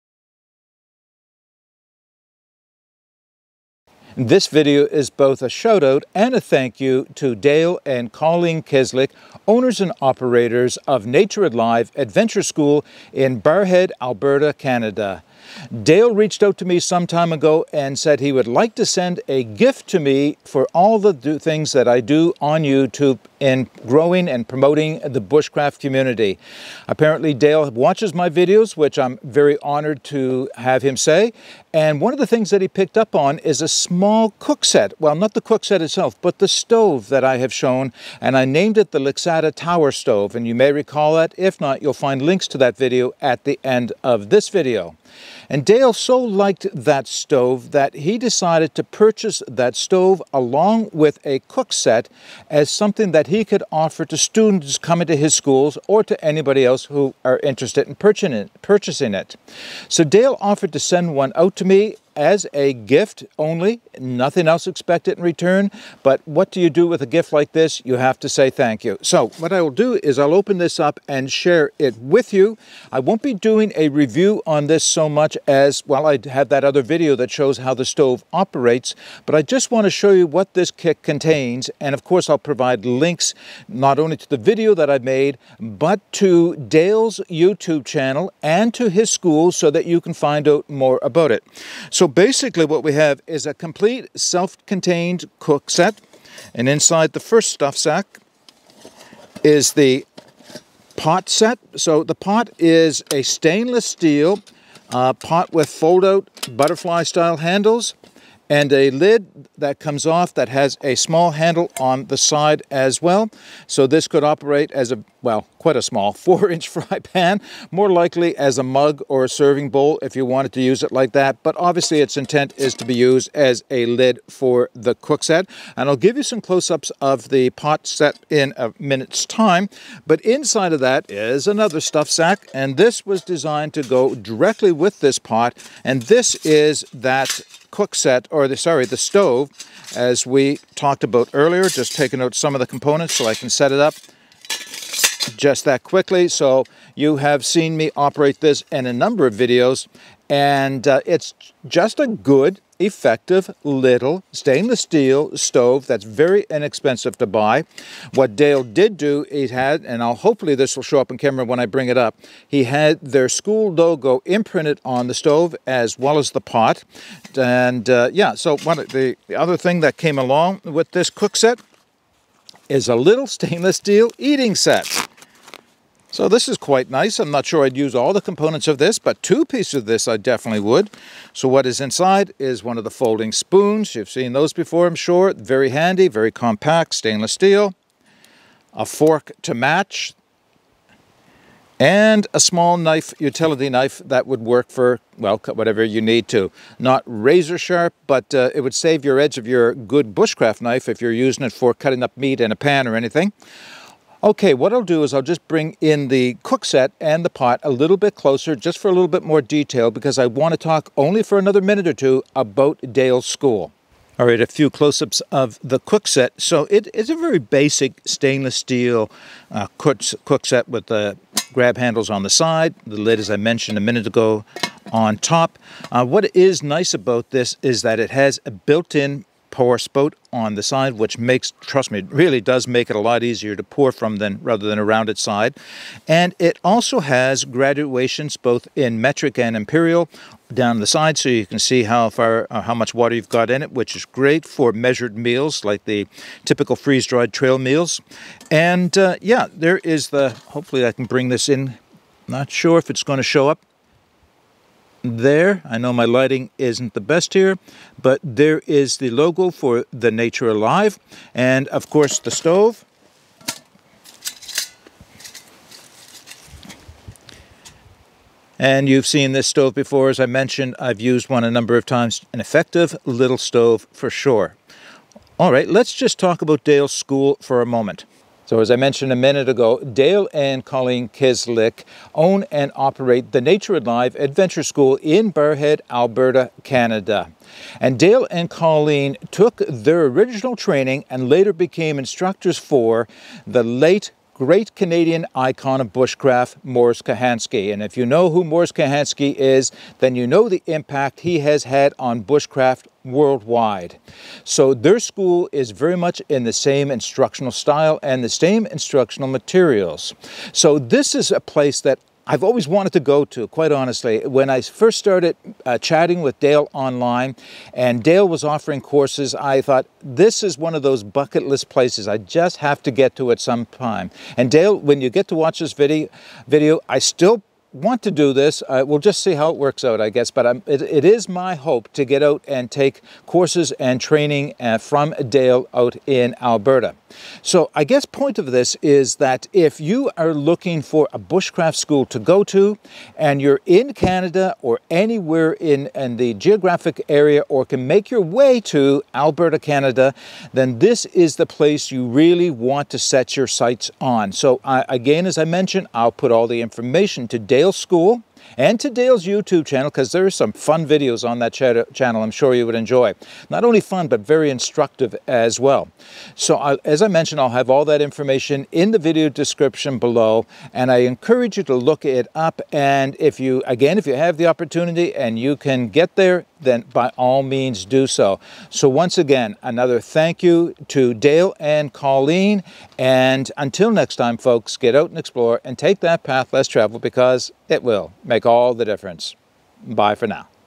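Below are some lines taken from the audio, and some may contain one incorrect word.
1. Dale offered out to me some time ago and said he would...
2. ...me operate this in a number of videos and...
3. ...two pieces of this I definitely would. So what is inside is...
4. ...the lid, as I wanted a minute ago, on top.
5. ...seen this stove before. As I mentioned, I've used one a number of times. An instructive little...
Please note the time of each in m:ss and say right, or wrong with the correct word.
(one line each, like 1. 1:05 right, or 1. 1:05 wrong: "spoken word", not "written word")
1. 0:15 wrong: "reached", not "offered"
2. 2:27 right
3. 2:59 right
4. 3:42 wrong: "mentioned", not "wanted"
5. 4:29 wrong: "effective", not "instructive".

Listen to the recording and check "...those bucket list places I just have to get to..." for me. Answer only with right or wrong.
right.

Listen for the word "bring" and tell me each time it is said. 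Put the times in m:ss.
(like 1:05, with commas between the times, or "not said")
2:41, 3:25, 4:11.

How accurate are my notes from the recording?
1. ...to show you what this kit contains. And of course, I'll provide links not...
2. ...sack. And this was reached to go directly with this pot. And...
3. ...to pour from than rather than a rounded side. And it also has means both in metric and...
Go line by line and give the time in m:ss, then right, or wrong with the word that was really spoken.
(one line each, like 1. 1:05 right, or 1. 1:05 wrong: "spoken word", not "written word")
1. 1:19 right
2. 2:12 wrong: "designed", not "reached"
3. 3:53 wrong: "graduations", not "means".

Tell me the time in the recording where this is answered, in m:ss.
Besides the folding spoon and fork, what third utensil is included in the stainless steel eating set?
3:13.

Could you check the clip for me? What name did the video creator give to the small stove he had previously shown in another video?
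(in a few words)
Lixada Tower Stove.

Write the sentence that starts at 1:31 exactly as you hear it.
So so basically what we have is a complete self-contained cook set.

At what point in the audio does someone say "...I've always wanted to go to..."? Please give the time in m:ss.
5:12.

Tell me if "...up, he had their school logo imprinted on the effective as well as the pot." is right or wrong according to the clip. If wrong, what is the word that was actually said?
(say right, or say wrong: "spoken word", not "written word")
wrong: "stove", not "effective".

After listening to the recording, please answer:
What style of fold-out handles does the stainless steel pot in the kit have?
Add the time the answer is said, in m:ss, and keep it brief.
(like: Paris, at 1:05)
Butterfly style, at 1:46.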